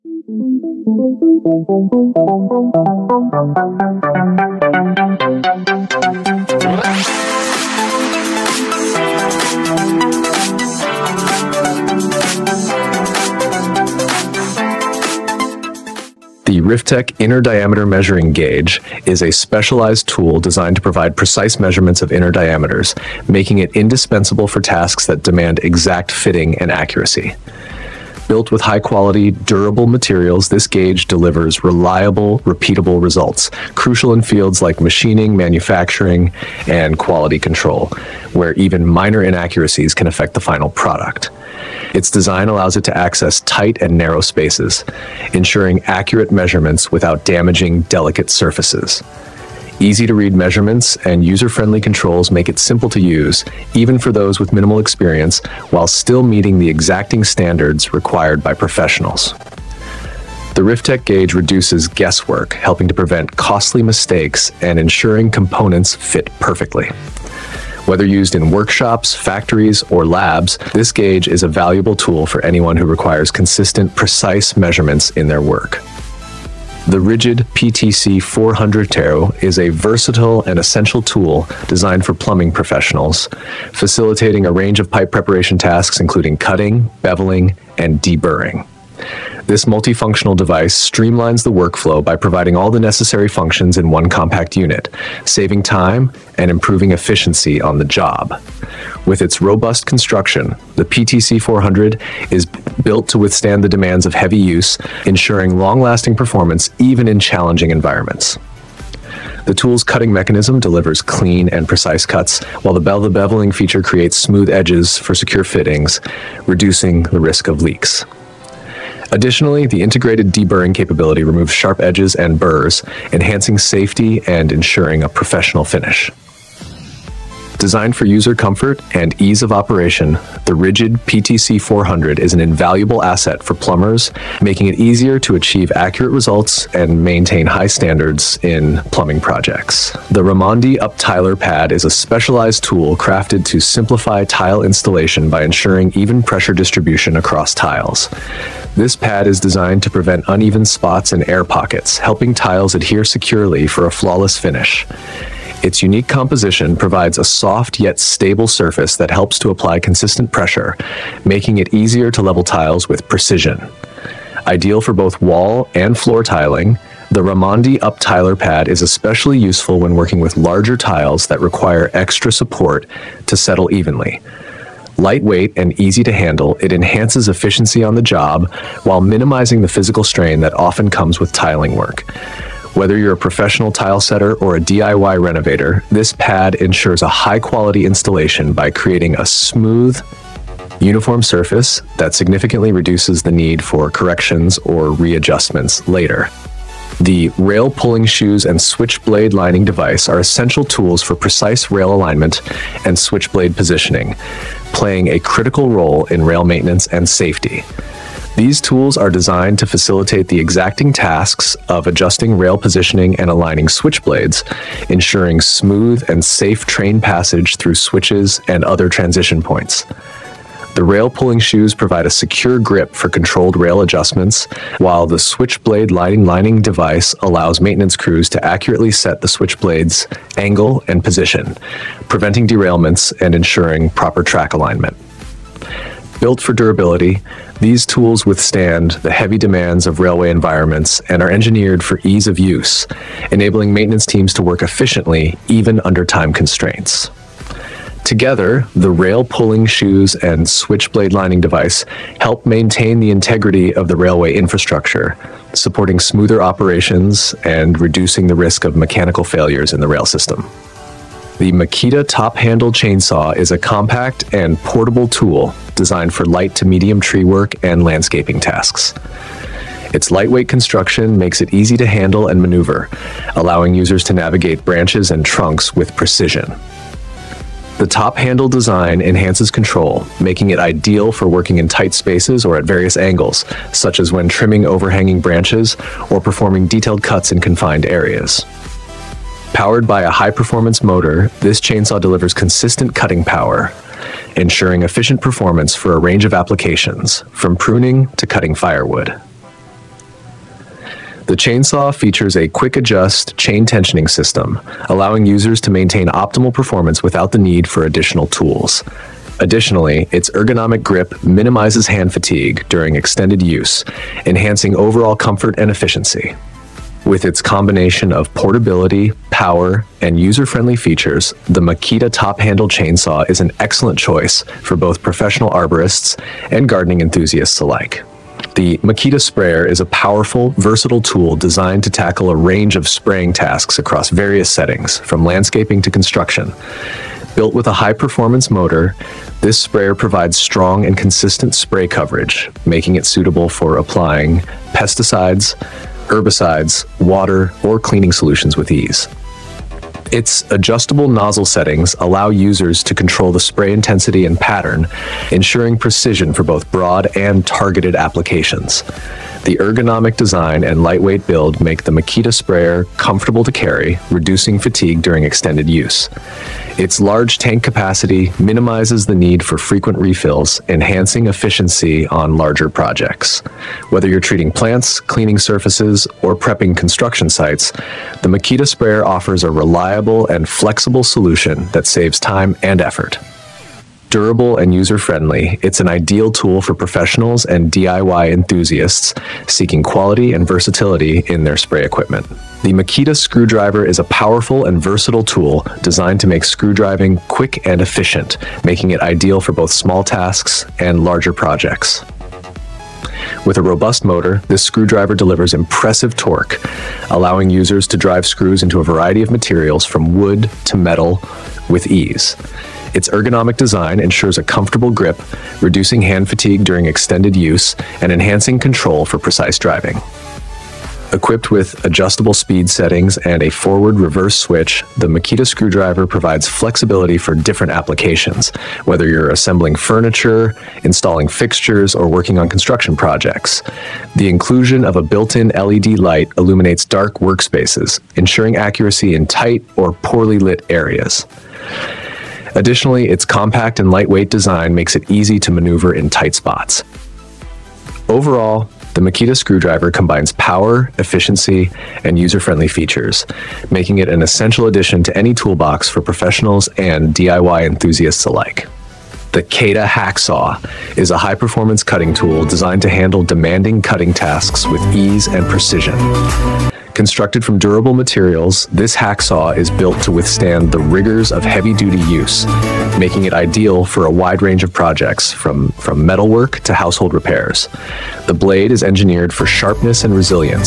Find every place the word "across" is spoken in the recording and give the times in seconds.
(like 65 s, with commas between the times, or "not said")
147 s, 333 s.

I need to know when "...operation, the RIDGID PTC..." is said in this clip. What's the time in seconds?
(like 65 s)
129 s.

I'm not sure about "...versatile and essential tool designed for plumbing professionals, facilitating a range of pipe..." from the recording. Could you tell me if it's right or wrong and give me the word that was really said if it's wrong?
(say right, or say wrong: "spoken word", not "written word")
right.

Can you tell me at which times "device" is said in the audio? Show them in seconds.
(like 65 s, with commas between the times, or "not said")
90 s, 199 s, 226 s, 251 s.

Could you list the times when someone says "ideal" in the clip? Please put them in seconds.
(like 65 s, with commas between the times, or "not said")
164 s, 280 s, 385 s, 398 s, 473 s.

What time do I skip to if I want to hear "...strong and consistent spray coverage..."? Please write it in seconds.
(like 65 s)
340 s.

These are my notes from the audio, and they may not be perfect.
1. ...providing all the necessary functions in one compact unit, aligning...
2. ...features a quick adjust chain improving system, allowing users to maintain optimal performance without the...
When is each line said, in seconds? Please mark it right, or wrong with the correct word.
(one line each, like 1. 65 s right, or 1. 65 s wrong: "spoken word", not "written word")
1. 92 s wrong: "saving", not "aligning"
2. 301 s wrong: "tensioning", not "improving".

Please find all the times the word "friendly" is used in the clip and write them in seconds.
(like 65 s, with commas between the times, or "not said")
51 s, 320 s, 384 s, 452 s.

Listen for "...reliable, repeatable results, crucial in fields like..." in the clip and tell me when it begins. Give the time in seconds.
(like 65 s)
31 s.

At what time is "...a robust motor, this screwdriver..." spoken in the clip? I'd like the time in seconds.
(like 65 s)
403 s.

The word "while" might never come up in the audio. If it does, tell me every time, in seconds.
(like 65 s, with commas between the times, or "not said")
55 s, 112 s, 178 s, 224 s.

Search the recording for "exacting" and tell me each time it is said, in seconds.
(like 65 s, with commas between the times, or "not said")
56 s, 210 s.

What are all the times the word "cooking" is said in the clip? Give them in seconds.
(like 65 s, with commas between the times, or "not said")
not said.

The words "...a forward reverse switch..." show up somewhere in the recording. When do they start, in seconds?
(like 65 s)
423 s.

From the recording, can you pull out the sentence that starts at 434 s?
The inclusion of a built-in LED light illuminates dark workspaces, ensuring accuracy in tight or poorly lit areas.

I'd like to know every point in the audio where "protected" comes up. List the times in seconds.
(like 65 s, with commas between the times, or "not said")
not said.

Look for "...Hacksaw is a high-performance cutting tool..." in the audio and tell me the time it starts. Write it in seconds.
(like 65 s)
459 s.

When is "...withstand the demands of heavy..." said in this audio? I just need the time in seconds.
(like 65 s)
103 s.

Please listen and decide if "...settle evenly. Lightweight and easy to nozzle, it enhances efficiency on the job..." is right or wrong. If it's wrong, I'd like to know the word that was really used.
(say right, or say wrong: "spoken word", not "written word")
wrong: "handle", not "nozzle".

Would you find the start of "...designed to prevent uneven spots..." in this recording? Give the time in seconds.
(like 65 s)
149 s.